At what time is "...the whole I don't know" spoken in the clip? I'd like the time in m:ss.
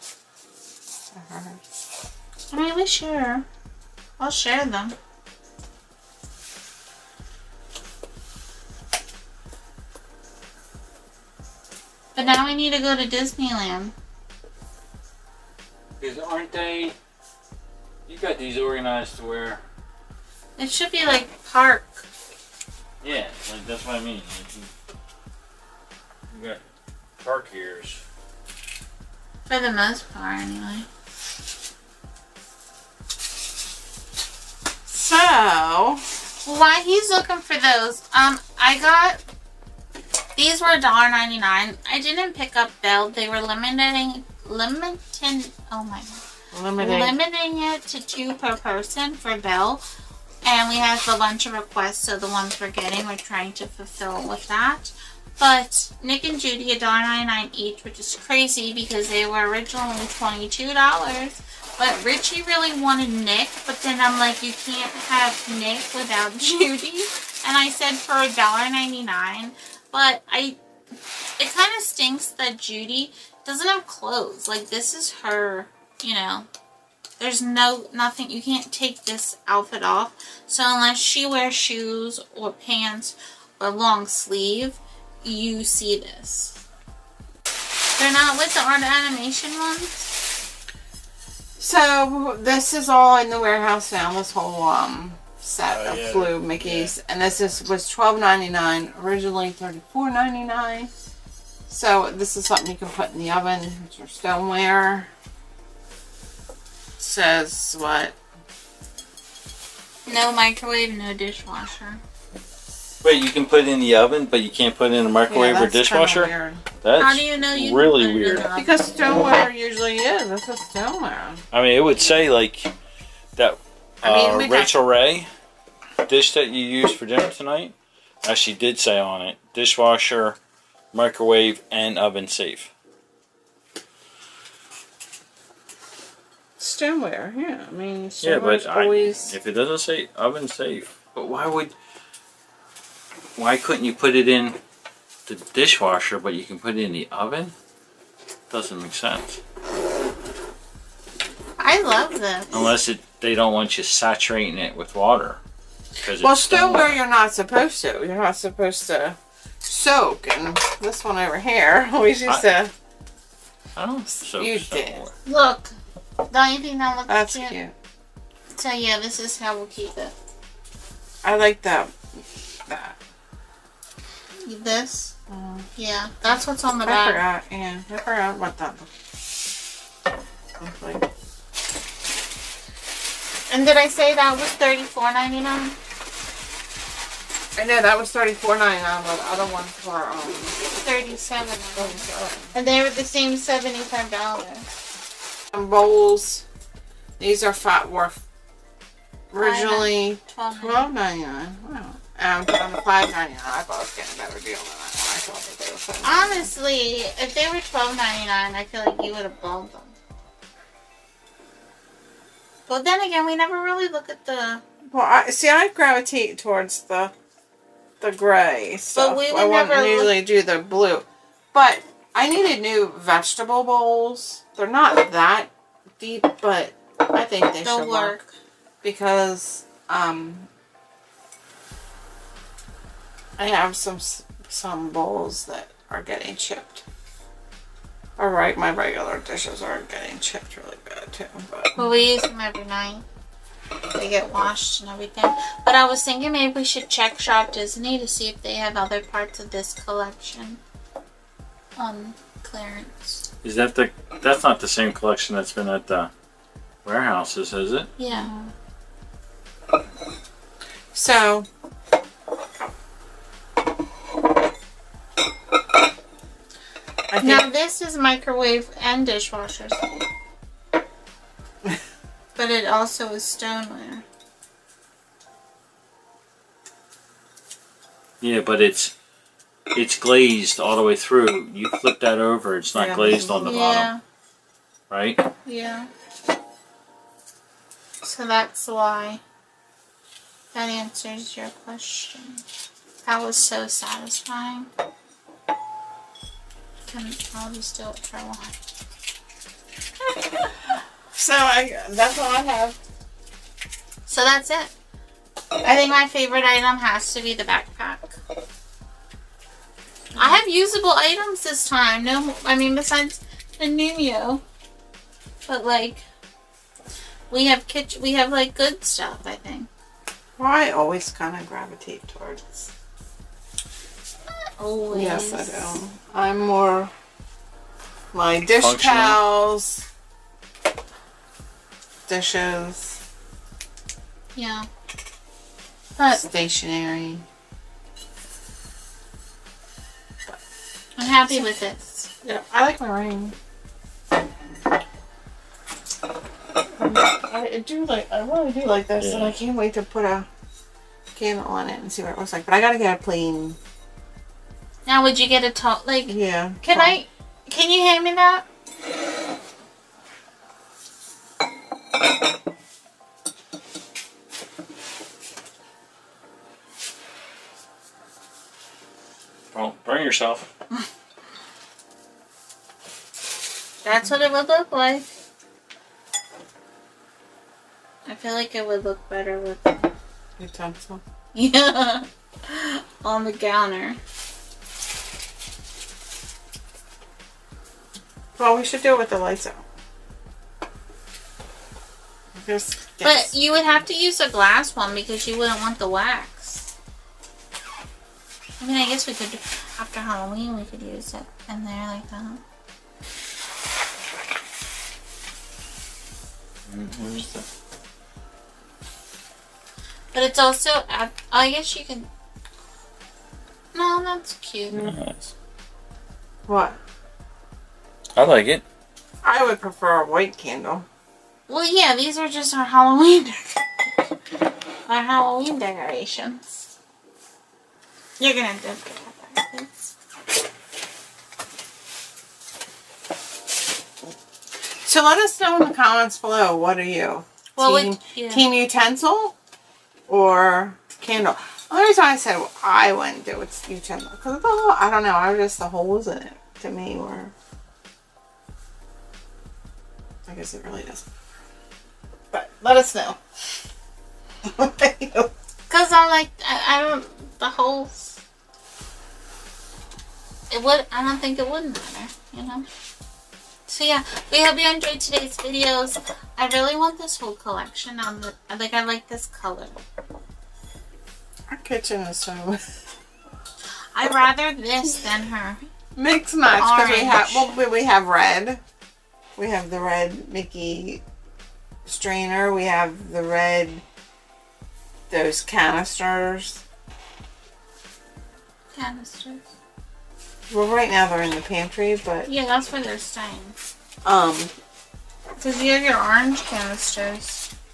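7:24.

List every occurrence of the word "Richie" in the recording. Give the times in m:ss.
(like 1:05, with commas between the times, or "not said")
1:02.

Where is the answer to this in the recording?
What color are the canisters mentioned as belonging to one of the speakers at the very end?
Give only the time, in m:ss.
8:15.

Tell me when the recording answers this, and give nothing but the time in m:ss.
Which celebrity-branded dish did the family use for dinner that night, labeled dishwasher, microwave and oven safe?
2:04.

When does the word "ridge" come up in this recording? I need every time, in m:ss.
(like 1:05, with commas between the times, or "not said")
not said.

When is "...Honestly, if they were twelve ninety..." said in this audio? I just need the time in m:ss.
3:26.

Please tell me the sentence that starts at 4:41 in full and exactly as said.
You flip that over, it's not yeah.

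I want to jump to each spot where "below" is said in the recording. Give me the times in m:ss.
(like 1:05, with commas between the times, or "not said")
7:16.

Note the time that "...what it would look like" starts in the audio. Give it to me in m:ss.
6:14.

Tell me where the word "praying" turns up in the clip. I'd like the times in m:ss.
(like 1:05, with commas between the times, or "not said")
not said.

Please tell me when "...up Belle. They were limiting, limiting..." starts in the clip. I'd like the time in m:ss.
0:42.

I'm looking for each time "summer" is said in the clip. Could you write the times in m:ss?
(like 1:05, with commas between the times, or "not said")
not said.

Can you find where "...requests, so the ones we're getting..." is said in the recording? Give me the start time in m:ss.
0:51.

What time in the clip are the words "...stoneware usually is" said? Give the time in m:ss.
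1:58.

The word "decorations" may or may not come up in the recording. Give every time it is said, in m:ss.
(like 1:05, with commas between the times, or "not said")
7:05.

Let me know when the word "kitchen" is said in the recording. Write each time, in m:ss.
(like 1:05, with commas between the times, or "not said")
5:17, 7:51.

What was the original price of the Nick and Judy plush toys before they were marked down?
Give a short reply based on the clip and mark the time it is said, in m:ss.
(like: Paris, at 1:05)
$22, at 0:59.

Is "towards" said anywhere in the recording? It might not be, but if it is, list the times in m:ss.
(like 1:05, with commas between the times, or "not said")
3:36, 5:22.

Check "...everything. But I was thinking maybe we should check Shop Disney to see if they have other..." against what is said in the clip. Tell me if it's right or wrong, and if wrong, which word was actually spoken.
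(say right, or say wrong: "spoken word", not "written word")
right.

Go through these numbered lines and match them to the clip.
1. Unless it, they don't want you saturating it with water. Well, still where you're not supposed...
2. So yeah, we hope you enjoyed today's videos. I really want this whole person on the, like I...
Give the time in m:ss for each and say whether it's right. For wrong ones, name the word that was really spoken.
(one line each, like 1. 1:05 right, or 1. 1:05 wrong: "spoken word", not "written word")
1. 2:32 right
2. 7:43 wrong: "collection", not "person".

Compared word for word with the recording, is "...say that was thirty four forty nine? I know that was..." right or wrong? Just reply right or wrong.
wrong.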